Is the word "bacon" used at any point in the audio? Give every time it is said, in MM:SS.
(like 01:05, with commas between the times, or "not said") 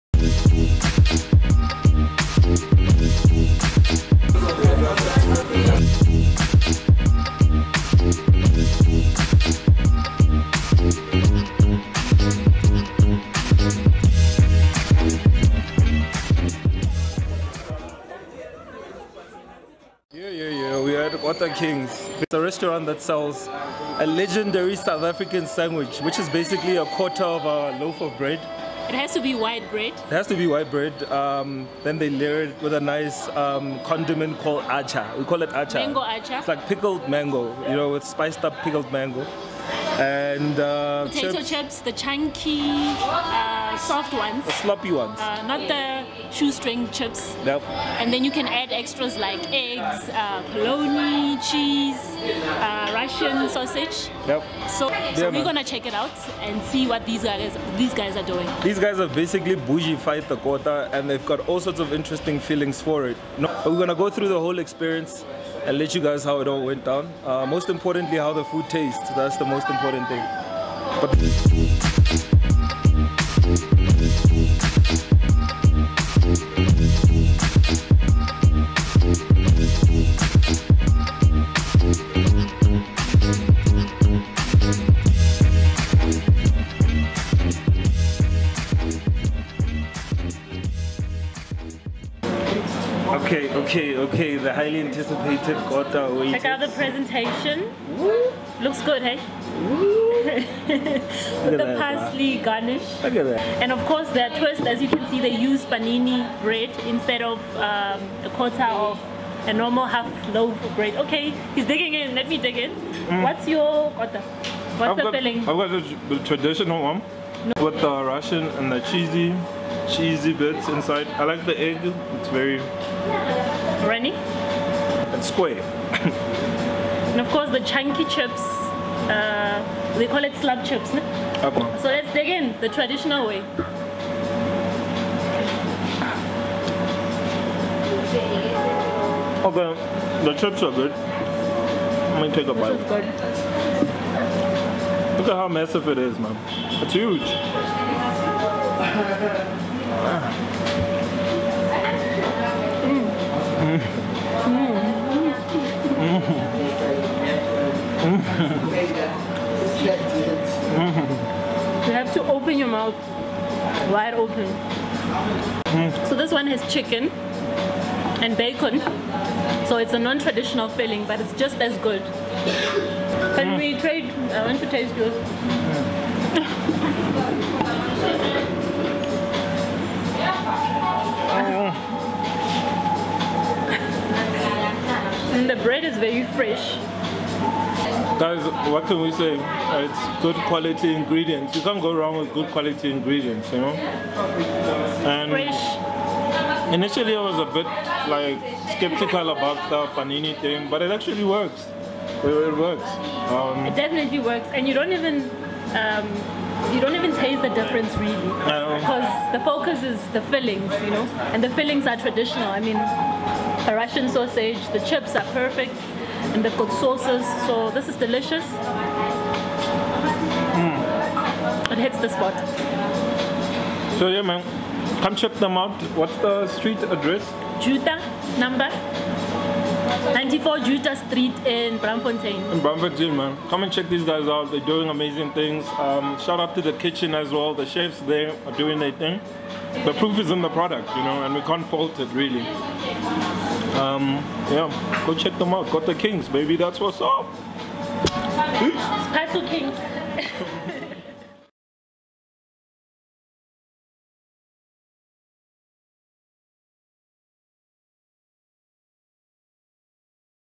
02:48.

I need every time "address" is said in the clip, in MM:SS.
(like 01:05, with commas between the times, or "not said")
03:46.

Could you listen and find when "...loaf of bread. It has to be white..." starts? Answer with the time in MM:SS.
00:27.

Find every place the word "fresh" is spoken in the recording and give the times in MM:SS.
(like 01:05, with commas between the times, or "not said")
03:06, 03:15.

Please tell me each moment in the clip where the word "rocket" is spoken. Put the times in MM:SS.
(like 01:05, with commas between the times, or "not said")
not said.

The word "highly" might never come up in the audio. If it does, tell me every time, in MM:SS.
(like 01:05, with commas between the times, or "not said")
01:34.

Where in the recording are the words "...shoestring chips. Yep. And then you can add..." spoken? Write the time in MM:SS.
00:46.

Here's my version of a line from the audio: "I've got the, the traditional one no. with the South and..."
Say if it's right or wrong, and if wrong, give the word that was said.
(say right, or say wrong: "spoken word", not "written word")
wrong: "Russian", not "South".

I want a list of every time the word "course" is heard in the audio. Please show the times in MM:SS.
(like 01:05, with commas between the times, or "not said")
01:43, 02:07.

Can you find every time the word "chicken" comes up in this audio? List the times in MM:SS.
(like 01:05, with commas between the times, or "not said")
02:46.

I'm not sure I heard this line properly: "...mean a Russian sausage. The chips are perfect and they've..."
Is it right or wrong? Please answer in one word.
right.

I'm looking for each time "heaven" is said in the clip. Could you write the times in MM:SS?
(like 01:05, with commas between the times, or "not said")
not said.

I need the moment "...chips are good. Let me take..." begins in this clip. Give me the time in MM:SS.
02:20.